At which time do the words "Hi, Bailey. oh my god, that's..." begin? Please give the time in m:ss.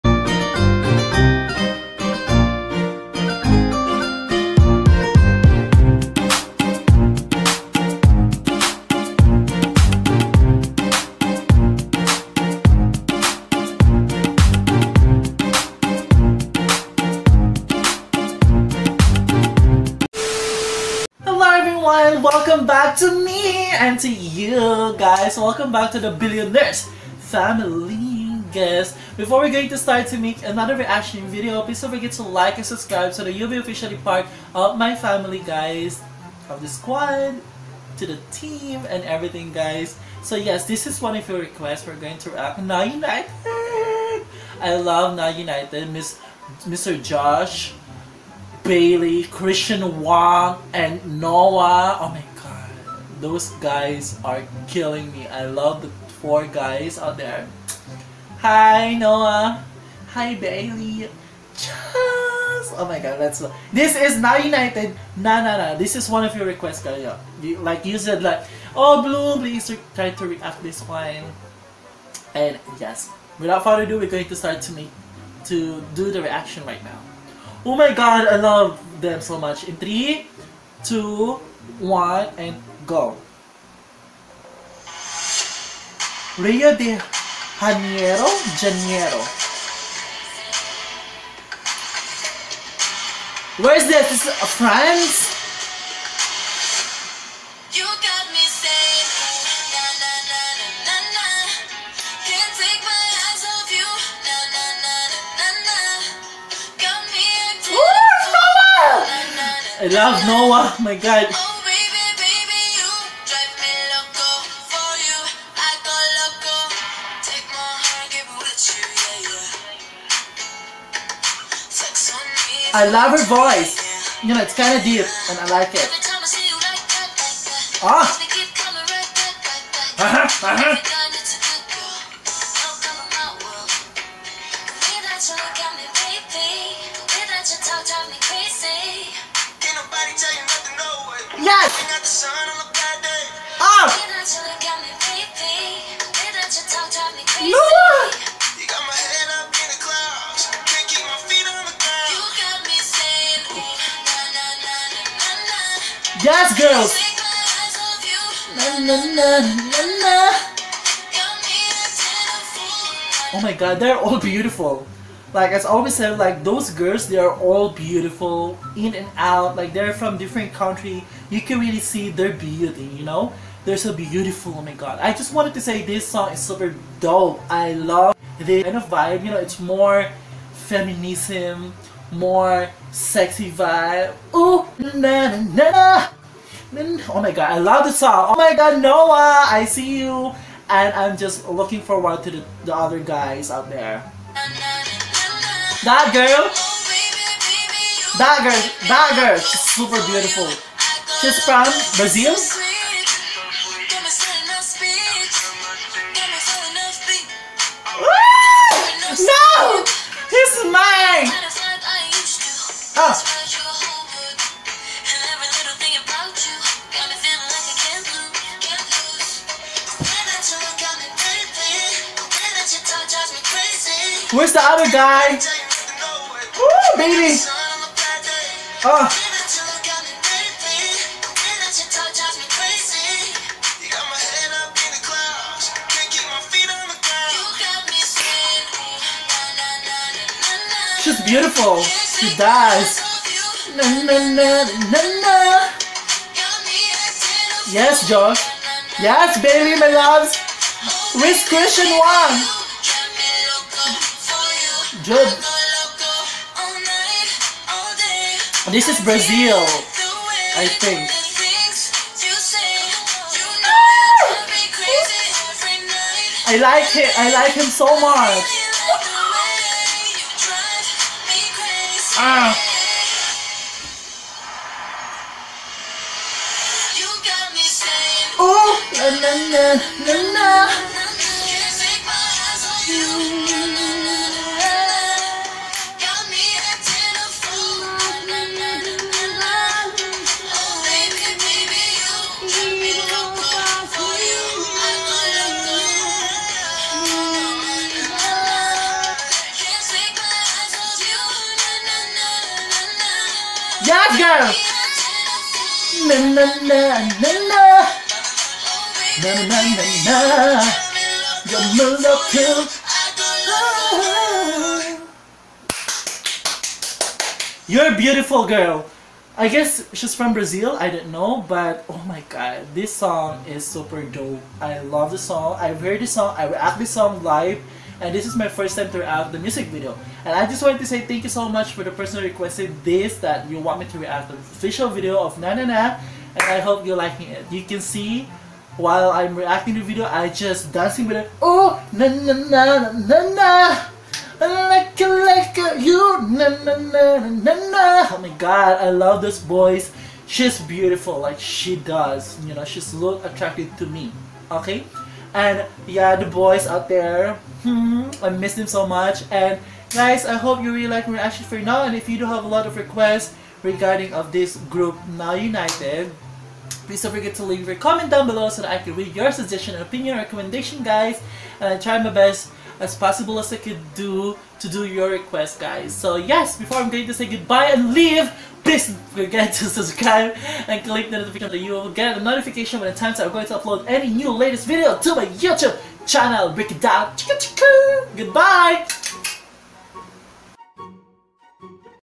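1:00.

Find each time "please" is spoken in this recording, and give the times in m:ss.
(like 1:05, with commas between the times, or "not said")
0:31, 1:09, 6:06, 6:18.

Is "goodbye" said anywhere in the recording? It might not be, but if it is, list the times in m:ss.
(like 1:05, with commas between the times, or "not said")
6:17, 6:28.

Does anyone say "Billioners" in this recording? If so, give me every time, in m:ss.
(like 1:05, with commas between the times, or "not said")
0:26.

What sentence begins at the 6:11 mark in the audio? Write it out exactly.
And I try my best as possible as I could do to do your request, guys.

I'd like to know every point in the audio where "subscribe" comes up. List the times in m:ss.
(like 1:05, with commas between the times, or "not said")
0:32, 6:19.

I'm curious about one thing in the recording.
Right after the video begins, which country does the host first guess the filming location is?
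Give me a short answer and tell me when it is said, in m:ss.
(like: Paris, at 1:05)
France, at 1:34.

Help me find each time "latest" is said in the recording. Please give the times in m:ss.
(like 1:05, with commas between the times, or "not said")
6:24.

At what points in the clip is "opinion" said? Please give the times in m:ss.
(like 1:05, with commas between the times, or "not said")
6:09.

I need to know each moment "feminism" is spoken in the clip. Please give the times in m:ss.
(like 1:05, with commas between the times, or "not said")
3:00.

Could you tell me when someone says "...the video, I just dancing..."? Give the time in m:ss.
5:39.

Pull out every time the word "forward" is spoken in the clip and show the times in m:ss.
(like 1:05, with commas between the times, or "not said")
3:11.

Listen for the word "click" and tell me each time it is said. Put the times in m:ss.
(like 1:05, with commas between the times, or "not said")
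6:20.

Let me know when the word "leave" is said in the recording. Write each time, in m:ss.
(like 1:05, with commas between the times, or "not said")
6:07, 6:17.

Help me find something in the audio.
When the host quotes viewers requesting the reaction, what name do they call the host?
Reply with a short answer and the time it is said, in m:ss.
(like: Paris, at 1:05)
Bloom, at 1:09.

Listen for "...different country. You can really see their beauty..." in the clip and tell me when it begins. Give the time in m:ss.
2:50.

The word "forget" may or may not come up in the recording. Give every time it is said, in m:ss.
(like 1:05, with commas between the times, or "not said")
0:31, 6:07, 6:19.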